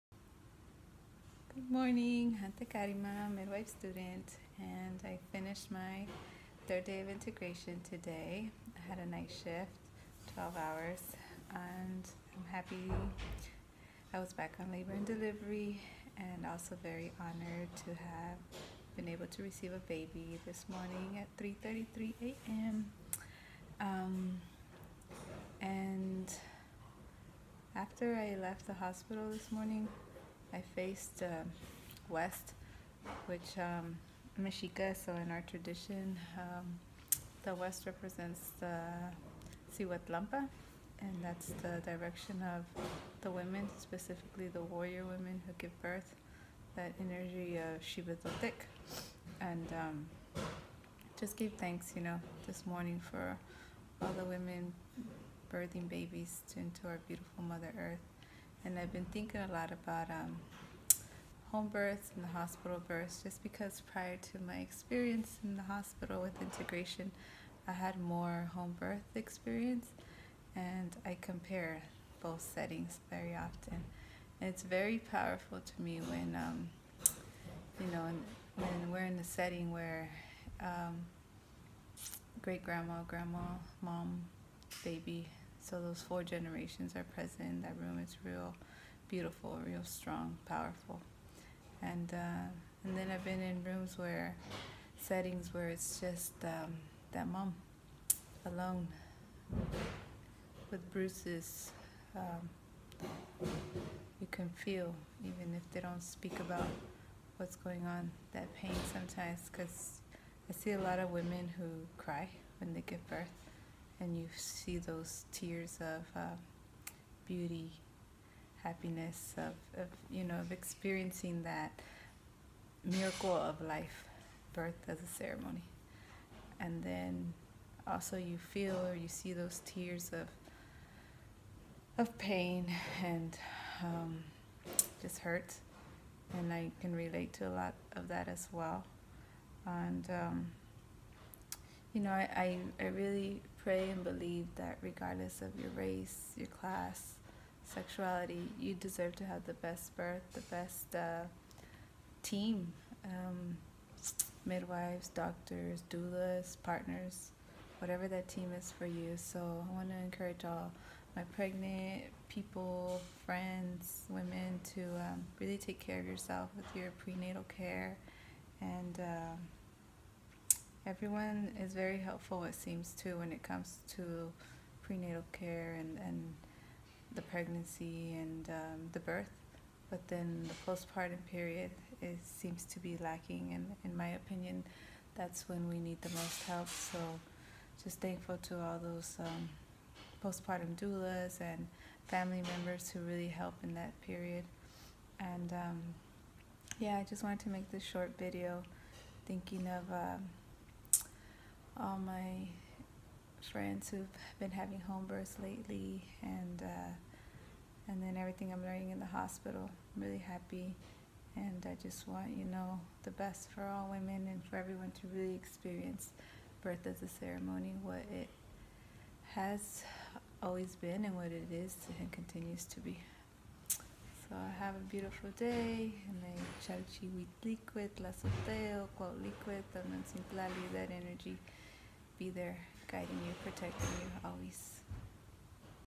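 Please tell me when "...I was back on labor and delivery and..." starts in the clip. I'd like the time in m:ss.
0:14.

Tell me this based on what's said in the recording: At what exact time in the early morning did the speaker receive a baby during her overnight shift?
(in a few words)
3:33 a.m.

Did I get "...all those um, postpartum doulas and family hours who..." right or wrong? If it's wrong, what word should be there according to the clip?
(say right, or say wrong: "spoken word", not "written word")
wrong: "members", not "hours".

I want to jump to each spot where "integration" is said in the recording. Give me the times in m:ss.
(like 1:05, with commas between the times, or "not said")
0:07, 1:06.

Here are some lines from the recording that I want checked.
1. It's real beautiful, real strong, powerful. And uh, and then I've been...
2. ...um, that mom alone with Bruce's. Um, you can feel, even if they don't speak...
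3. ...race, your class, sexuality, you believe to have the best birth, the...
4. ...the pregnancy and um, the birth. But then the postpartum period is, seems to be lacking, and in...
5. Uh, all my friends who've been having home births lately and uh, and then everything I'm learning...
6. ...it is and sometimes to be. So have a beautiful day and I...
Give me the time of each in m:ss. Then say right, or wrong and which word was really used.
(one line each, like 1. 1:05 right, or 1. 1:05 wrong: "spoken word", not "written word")
1. 1:28 right
2. 1:36 right
3. 2:25 wrong: "deserve", not "believe"
4. 2:57 right
5. 3:19 right
6. 3:41 wrong: "continues", not "sometimes".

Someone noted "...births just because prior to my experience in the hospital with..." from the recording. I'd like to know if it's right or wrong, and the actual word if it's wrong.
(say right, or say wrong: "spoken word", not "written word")
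right.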